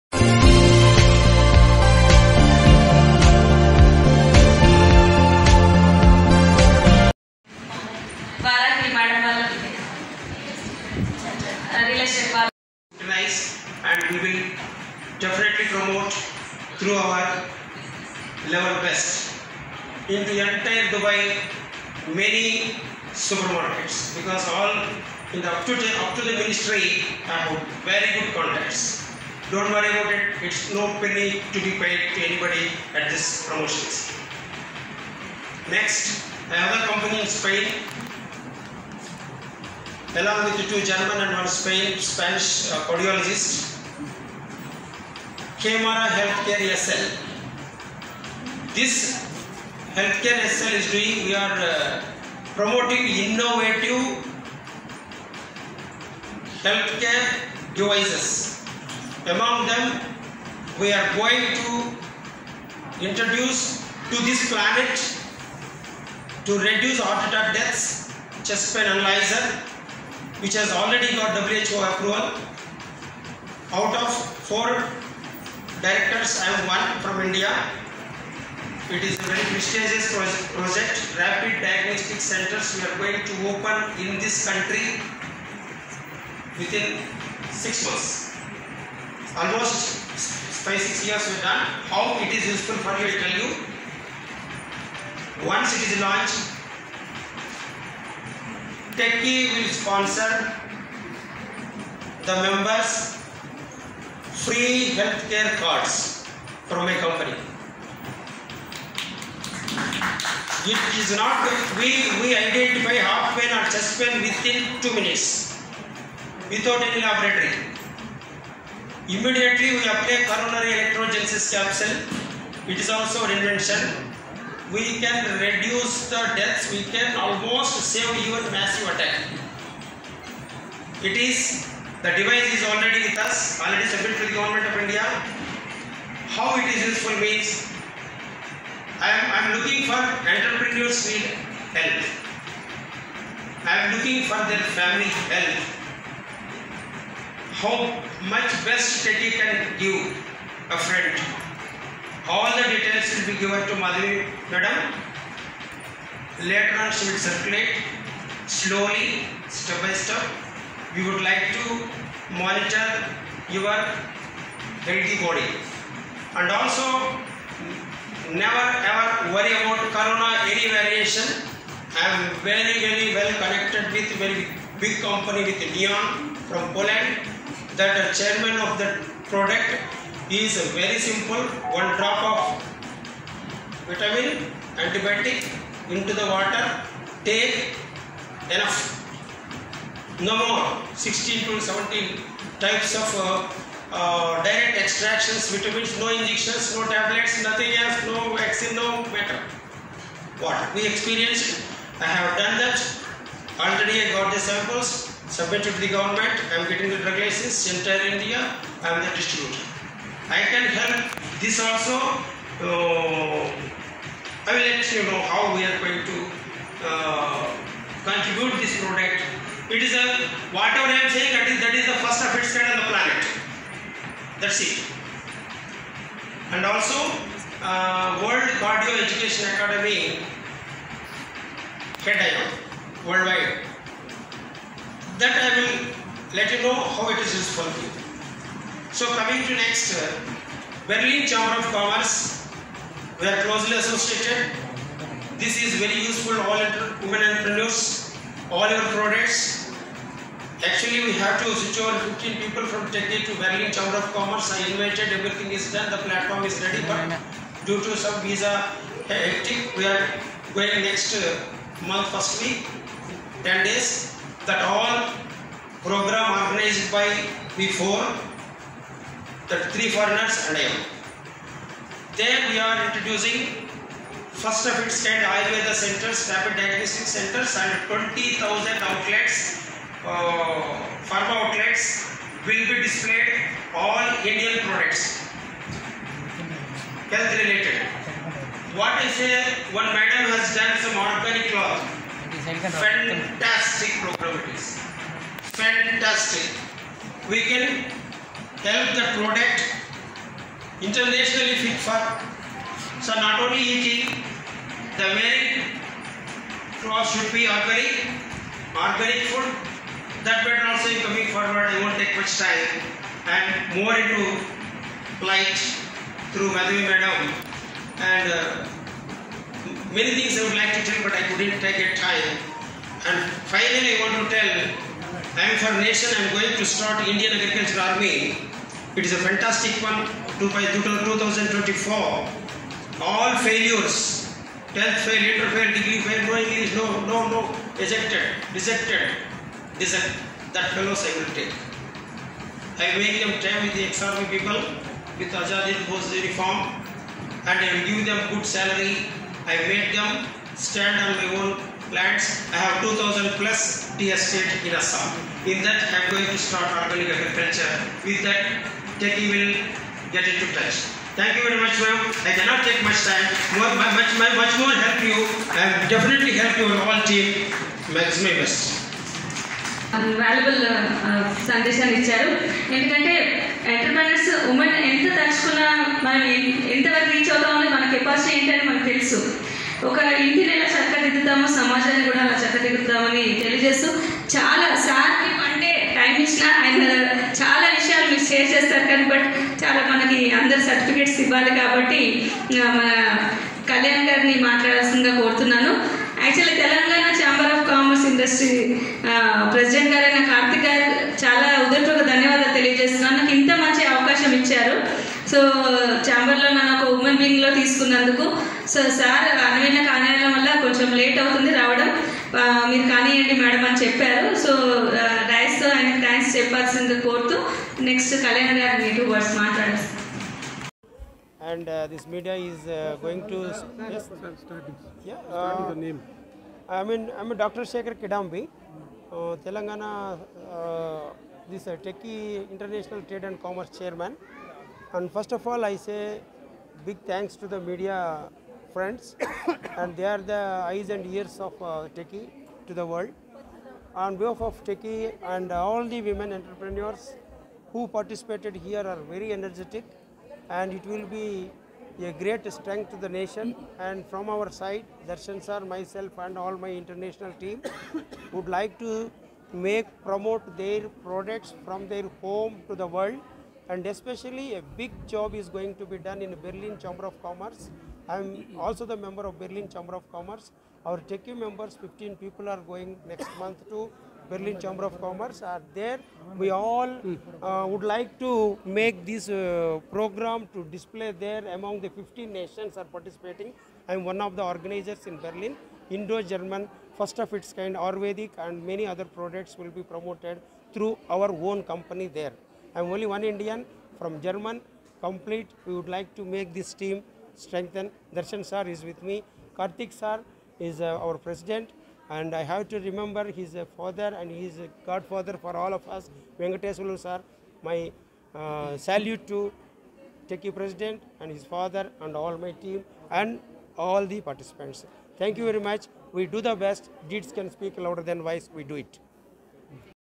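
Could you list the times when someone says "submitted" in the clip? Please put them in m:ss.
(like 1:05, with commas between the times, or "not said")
2:13, 3:25.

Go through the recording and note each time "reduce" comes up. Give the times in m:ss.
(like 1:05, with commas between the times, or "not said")
1:06, 2:05.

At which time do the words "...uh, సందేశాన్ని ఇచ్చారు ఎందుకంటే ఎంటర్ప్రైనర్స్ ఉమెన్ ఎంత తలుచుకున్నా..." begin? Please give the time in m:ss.
6:11.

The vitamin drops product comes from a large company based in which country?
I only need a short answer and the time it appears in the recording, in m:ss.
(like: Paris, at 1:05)
Poland, at 2:56.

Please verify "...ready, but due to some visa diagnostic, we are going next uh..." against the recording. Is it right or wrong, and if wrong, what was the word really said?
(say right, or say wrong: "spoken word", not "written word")
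wrong: "hectic", not "diagnostic".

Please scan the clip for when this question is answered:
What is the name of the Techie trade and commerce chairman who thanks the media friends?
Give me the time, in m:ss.
7:07.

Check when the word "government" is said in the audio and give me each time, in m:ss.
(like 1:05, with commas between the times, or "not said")
2:14, 3:25.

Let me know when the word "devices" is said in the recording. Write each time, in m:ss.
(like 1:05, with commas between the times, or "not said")
0:57, 2:12.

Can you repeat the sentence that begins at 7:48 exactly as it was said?
I'm also the member of Berlin Chamber of Commerce.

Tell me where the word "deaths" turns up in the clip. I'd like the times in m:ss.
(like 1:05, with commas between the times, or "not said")
1:07, 2:06.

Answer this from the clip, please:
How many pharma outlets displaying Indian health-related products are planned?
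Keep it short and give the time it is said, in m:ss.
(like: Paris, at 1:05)
20,000, at 4:37.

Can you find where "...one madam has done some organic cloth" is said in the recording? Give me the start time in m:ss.
4:49.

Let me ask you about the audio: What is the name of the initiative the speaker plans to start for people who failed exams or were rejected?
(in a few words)
Indian Agriculture Army.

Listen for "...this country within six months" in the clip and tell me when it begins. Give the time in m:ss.
1:24.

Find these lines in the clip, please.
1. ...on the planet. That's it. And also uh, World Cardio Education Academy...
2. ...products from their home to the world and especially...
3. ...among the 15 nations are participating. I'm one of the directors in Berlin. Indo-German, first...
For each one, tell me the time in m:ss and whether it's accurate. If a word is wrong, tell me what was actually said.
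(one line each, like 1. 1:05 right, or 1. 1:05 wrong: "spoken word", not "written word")
1. 3:42 right
2. 7:41 right
3. 8:01 wrong: "organizers", not "directors".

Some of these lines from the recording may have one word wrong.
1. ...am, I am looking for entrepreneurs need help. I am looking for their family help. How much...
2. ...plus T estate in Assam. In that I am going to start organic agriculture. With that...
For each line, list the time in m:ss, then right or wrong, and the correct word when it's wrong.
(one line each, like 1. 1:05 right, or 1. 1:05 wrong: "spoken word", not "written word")
1. 2:19 right
2. 5:53 right.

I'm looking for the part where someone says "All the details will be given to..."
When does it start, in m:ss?
2:32.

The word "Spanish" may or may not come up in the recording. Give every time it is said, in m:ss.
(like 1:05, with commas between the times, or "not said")
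0:41.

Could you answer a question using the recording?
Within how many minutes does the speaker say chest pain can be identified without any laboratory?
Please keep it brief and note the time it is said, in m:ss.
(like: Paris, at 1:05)
2 minutes, at 1:54.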